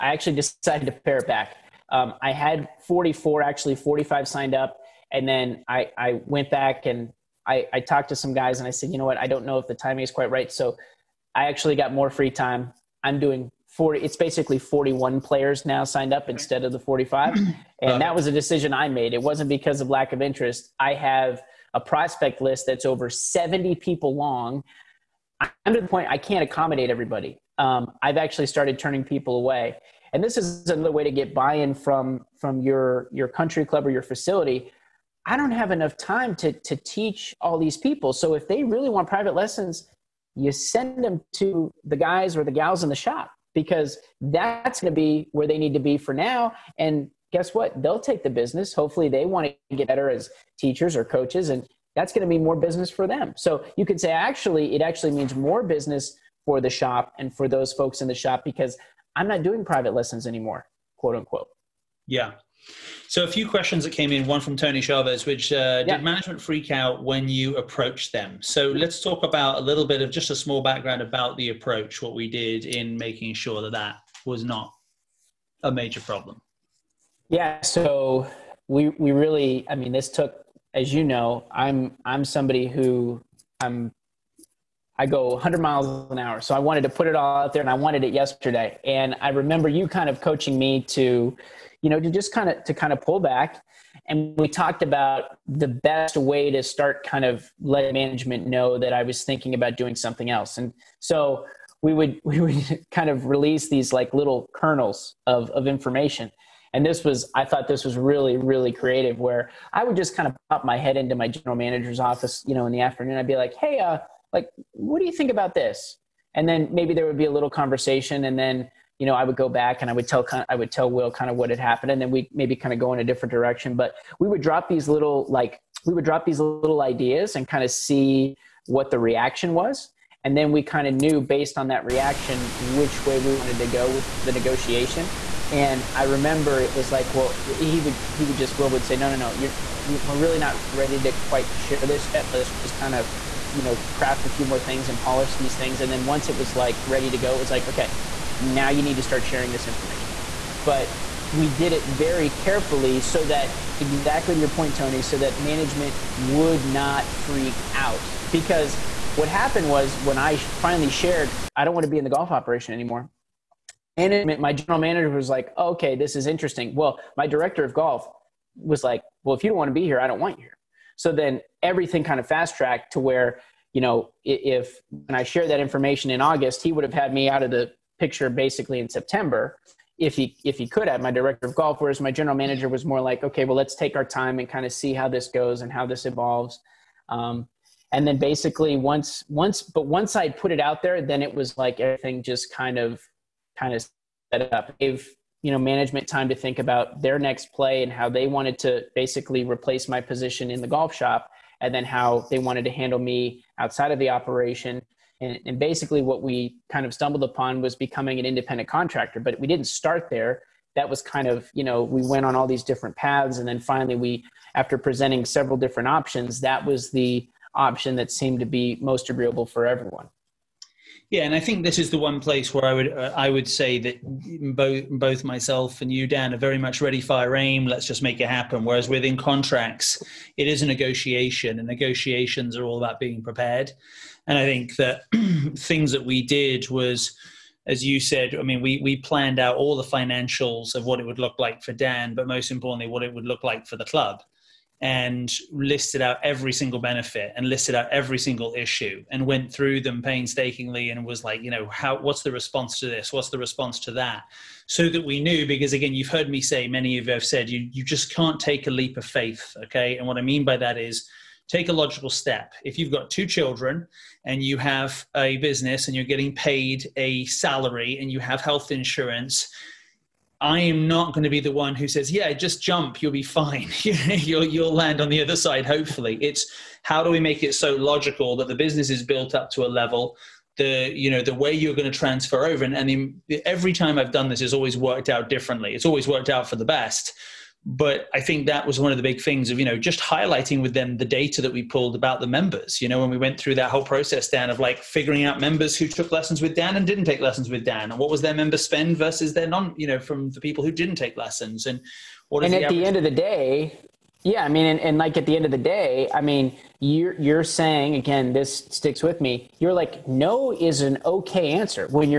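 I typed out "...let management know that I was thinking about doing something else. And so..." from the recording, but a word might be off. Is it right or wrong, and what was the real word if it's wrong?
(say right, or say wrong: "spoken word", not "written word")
right.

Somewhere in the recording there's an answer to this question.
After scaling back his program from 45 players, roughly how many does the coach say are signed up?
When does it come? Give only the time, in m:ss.
0:14.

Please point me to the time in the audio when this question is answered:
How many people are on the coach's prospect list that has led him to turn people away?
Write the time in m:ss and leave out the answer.
0:22.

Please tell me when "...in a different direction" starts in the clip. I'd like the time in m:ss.
2:02.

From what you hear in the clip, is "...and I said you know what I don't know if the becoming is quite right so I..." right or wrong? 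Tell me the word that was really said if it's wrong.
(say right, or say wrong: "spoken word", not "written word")
wrong: "timing", not "becoming".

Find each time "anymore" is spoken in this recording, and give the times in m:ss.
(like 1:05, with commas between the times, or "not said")
1:00, 2:42.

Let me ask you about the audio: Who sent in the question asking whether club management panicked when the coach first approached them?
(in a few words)
Tony Chavez.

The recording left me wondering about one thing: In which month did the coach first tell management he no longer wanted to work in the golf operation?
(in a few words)
August.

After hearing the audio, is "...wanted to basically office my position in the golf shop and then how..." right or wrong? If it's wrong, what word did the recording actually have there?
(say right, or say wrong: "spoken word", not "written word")
wrong: "replace", not "office".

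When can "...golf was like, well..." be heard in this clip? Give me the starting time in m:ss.
2:47.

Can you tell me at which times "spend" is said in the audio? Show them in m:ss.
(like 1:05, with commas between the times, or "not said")
4:58.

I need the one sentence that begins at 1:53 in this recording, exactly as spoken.
I'd be like, hey, uh, like, what do you think about this?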